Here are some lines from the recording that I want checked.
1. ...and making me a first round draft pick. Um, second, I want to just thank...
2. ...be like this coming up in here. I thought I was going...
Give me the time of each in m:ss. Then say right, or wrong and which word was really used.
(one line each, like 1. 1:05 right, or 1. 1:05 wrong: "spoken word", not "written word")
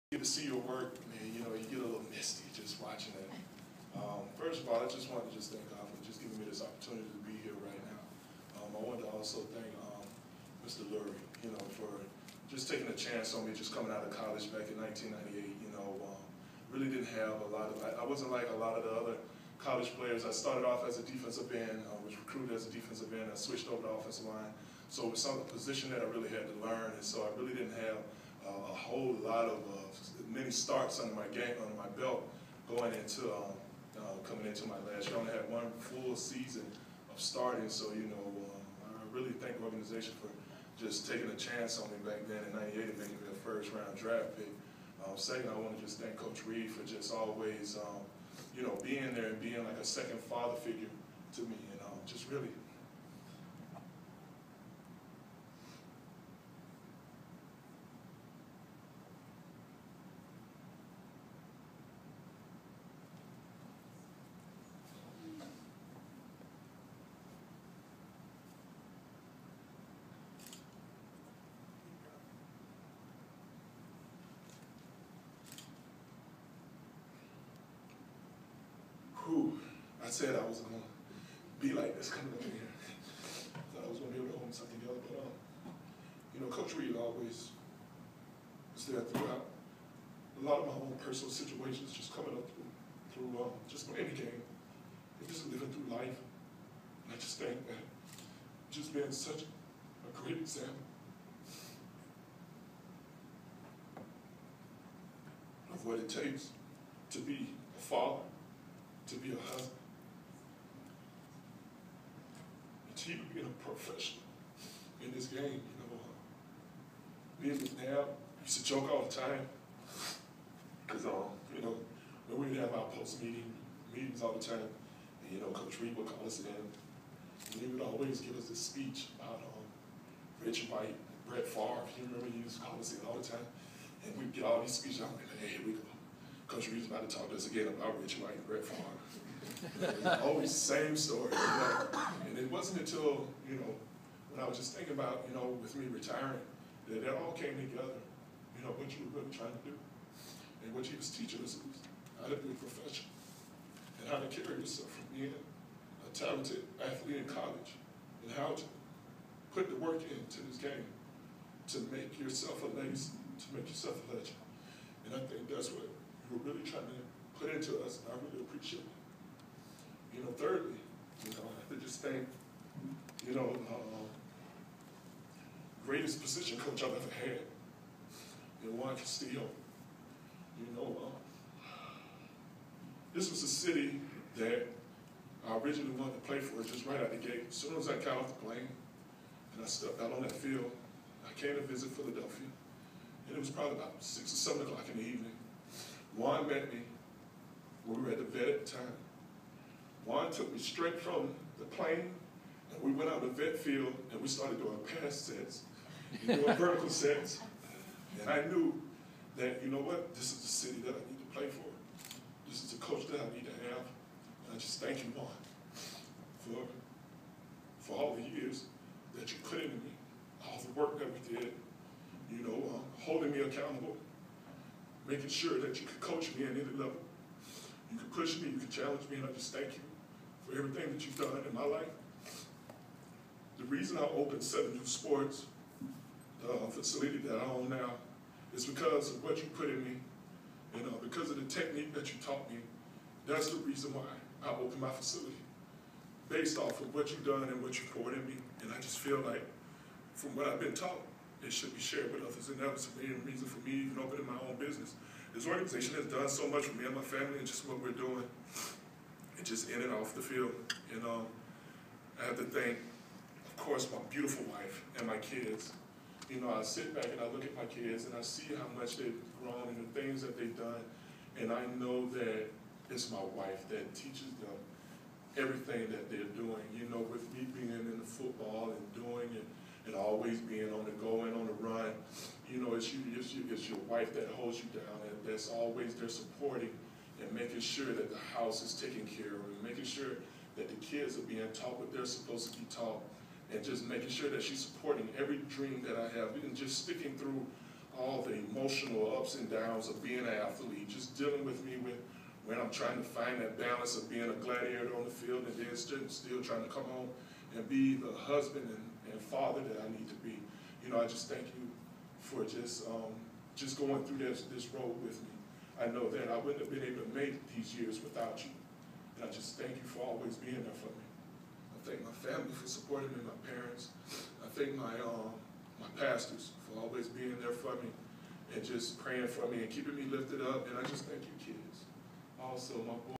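1. 0:42 right
2. 1:21 right.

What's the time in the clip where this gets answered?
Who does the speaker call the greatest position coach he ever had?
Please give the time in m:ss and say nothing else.
2:58.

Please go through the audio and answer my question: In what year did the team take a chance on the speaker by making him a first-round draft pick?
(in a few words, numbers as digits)
1998.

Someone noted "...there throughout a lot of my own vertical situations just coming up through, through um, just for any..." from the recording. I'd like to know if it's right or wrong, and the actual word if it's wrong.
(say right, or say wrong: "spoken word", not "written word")
wrong: "personal", not "vertical".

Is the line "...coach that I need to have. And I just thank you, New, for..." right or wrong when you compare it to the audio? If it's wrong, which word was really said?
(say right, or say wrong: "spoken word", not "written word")
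wrong: "Juan", not "New".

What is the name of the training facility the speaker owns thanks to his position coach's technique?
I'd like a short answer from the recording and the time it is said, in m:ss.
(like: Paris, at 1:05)
Seven New Sports, at 3:54.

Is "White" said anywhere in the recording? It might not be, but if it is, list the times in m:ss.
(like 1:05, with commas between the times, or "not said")
2:10, 2:18.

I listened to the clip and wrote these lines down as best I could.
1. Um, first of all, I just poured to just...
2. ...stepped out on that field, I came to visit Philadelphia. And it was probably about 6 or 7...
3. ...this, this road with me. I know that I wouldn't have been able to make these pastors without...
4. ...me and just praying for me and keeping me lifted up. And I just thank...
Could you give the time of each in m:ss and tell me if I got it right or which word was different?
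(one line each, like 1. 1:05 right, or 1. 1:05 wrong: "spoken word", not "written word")
1. 0:03 wrong: "wanted", not "poured"
2. 3:09 right
3. 5:14 wrong: "years", not "pastors"
4. 5:27 right.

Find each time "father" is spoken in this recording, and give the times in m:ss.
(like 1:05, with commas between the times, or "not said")
0:50, 1:47, 5:09.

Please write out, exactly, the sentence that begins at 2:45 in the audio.
And I think that's what you were really trying to put into us, and I really appreciate it.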